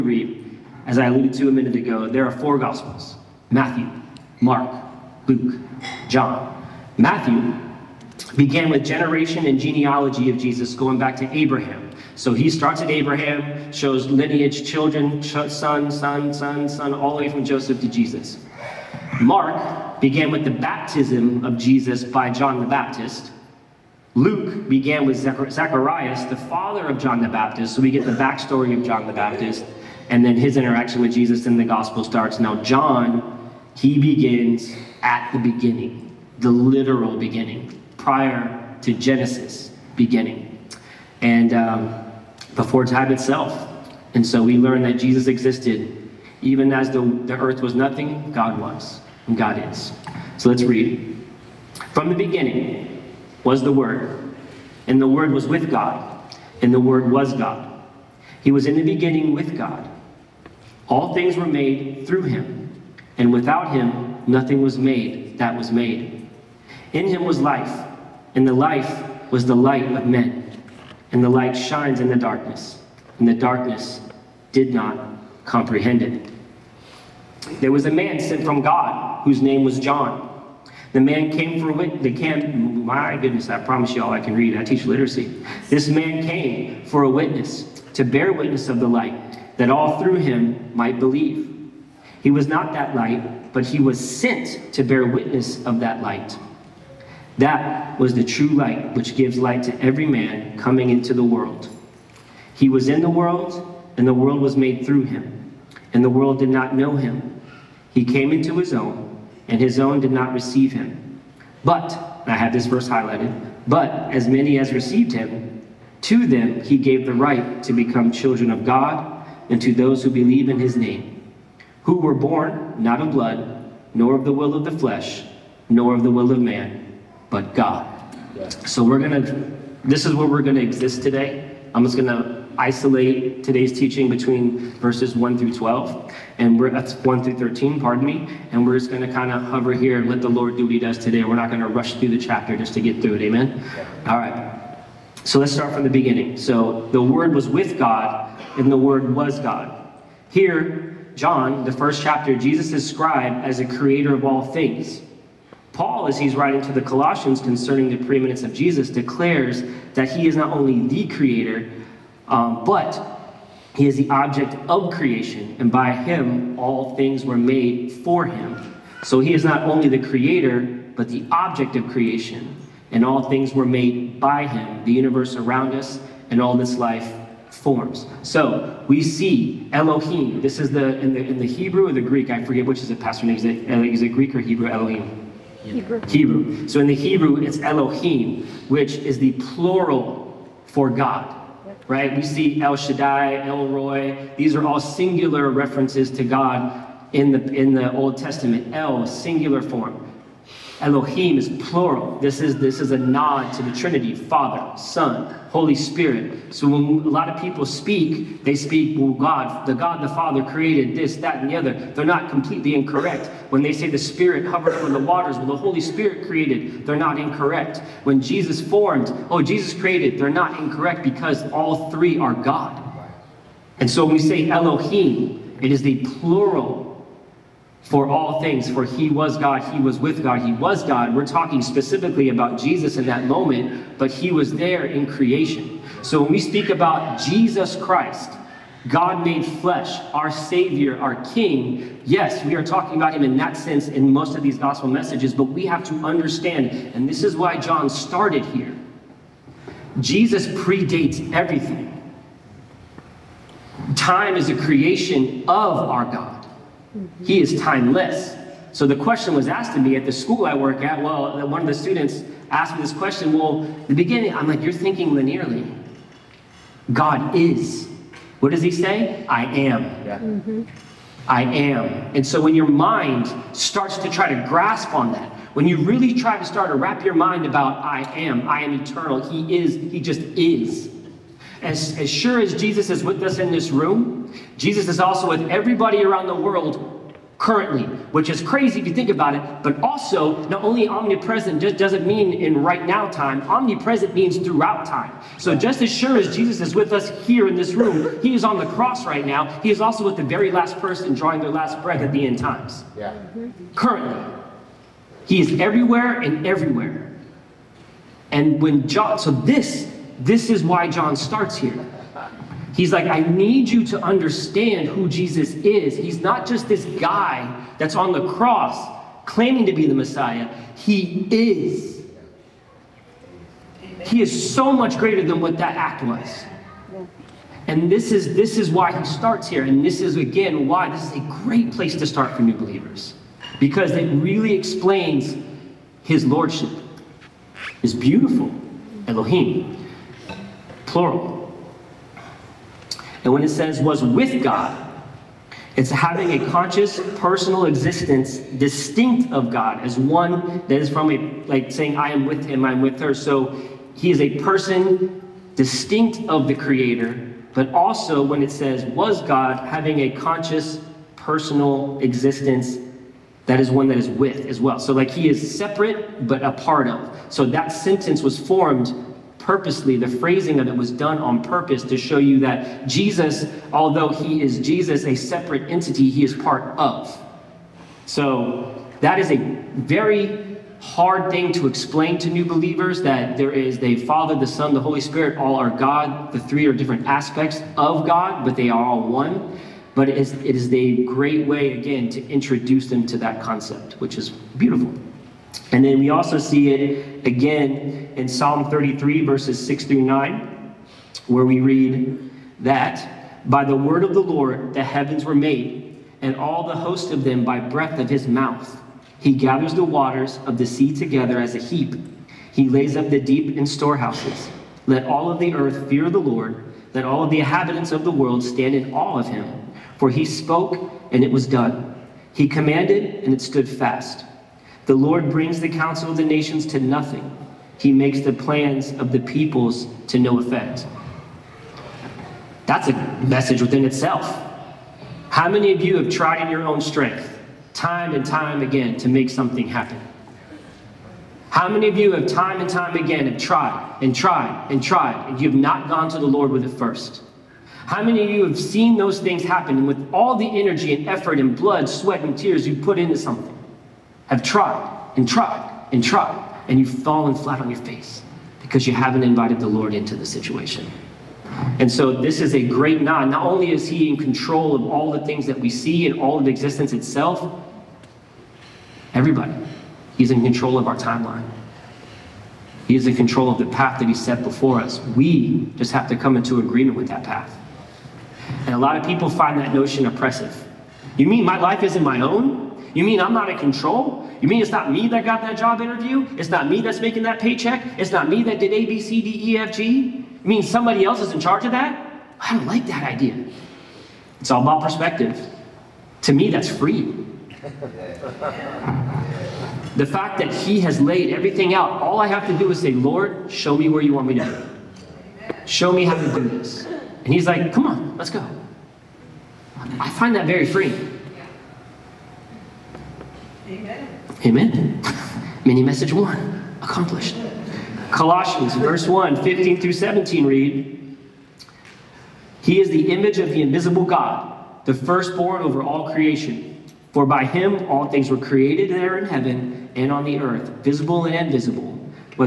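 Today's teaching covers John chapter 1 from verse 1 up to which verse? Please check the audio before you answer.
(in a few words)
13.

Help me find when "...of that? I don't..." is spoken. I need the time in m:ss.
8:11.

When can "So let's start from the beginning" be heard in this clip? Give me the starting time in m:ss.
2:25.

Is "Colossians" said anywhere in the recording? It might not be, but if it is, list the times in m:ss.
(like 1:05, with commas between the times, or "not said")
2:36, 8:38.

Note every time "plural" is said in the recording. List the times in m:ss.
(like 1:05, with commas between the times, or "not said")
3:09, 3:21, 3:46, 5:40.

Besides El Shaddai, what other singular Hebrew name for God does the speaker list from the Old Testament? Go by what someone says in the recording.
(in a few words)
El Roi.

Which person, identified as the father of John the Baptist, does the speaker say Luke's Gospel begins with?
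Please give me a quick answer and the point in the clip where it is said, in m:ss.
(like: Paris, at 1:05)
Zacharias, at 0:25.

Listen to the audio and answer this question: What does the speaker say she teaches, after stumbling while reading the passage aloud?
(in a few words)
literacy.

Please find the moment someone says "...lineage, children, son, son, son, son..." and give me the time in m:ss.
0:14.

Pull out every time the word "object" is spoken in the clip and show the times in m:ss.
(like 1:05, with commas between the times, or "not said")
2:44, 2:51.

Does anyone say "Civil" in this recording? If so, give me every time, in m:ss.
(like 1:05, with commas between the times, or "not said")
not said.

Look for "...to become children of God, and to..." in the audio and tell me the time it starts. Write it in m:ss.
1:57.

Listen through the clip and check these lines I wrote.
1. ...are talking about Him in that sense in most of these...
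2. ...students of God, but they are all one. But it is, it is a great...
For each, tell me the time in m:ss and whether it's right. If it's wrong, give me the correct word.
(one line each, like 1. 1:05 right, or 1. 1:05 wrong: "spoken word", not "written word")
1. 4:02 right
2. 6:27 wrong: "aspects", not "students".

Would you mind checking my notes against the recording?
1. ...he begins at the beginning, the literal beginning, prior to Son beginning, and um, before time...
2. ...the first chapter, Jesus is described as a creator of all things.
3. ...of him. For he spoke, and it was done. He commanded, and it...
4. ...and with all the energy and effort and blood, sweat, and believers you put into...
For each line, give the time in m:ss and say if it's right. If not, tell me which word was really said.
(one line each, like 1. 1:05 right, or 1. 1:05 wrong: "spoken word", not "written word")
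1. 0:33 wrong: "Genesis", not "Son"
2. 2:31 right
3. 6:59 right
4. 7:29 wrong: "tears", not "believers".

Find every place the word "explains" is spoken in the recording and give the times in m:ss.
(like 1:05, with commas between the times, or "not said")
5:34, 6:21.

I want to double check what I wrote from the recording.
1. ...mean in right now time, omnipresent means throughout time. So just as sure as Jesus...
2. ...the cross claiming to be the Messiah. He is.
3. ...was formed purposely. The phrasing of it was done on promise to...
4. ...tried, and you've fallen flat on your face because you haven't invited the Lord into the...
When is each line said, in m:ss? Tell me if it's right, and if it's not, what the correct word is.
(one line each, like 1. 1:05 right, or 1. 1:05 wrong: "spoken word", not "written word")
1. 4:52 right
2. 5:18 right
3. 6:08 wrong: "purpose", not "promise"
4. 7:36 right.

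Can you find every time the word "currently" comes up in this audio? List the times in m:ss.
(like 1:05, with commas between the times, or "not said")
4:47, 5:03.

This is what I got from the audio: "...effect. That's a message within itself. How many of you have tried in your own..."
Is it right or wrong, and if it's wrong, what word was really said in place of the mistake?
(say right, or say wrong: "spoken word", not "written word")
right.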